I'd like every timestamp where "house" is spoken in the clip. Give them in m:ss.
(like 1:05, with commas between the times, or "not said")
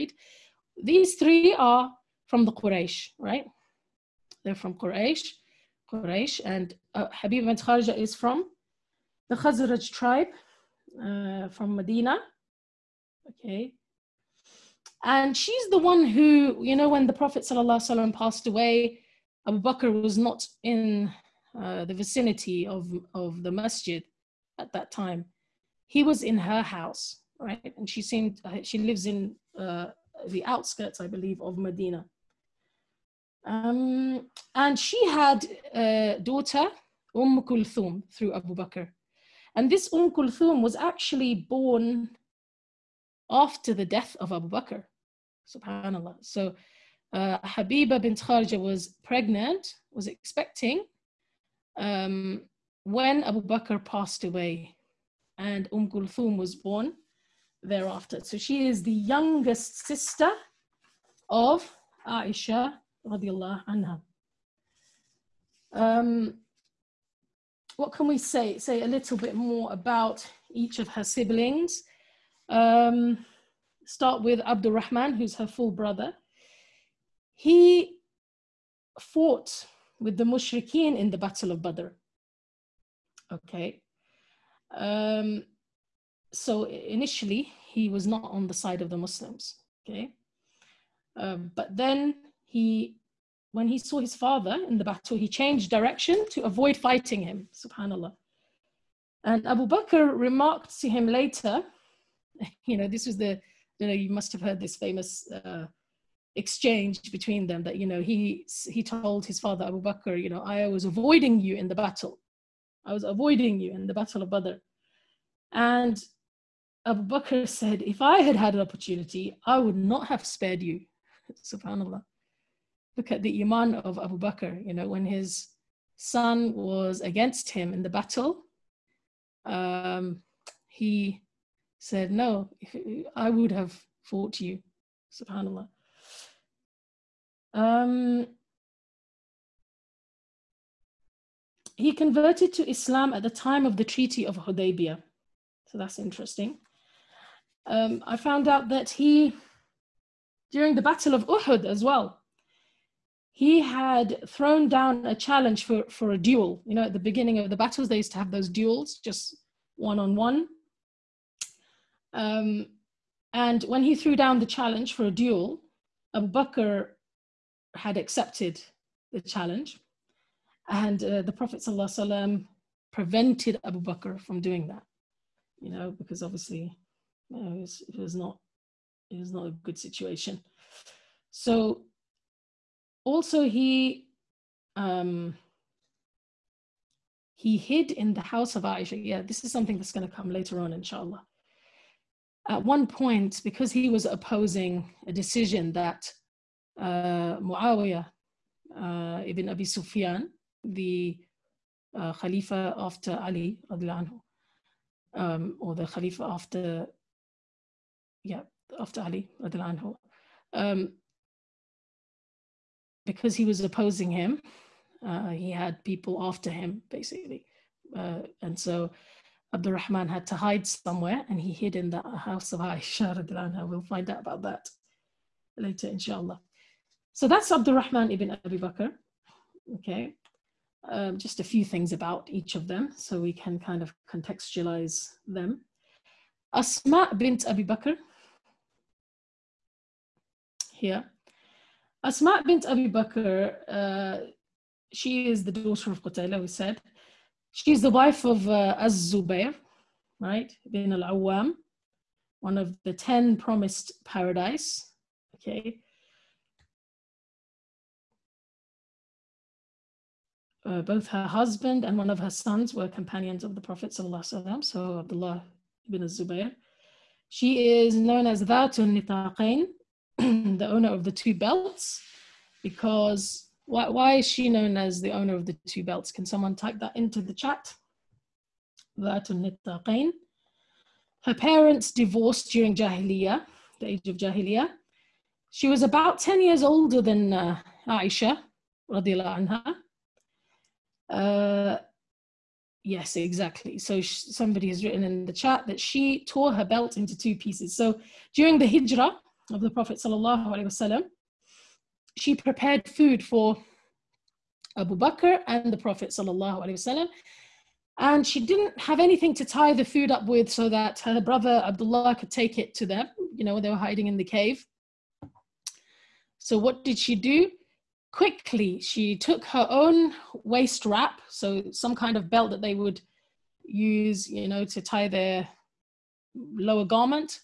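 0:26, 3:08, 3:42.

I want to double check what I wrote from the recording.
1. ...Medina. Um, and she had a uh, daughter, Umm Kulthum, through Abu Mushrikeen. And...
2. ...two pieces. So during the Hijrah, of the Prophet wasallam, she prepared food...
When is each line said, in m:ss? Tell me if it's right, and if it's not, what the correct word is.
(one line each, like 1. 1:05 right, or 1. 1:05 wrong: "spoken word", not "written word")
1. 0:31 wrong: "Bakr", not "Mushrikeen"
2. 4:57 right.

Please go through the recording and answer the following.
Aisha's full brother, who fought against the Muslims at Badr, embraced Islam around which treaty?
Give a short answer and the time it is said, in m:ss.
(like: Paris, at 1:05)
Treaty of Hudaybiyah, at 2:23.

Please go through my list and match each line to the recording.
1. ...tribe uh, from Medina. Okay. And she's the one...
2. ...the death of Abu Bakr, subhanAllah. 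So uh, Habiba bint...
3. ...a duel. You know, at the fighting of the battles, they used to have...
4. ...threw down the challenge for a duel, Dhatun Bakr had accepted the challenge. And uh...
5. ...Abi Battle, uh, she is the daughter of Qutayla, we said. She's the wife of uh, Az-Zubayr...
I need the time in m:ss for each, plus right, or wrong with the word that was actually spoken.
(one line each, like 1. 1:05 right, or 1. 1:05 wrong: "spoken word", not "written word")
1. 0:09 right
2. 0:43 right
3. 2:36 wrong: "beginning", not "fighting"
4. 2:43 wrong: "Abu", not "Dhatun"
5. 4:02 wrong: "Bakr", not "Battle".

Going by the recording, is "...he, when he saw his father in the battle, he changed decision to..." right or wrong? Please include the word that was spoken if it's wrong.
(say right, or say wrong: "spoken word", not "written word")
wrong: "direction", not "decision".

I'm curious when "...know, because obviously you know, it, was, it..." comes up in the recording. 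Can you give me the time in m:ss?
2:55.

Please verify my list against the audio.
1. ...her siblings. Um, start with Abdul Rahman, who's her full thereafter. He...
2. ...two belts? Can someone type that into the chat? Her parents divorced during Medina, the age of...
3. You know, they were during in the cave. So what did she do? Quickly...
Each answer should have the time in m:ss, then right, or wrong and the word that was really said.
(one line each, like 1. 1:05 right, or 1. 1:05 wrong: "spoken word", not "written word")
1. 1:10 wrong: "brother", not "thereafter"
2. 4:35 wrong: "Jahiliyyah", not "Medina"
3. 5:13 wrong: "hiding", not "during".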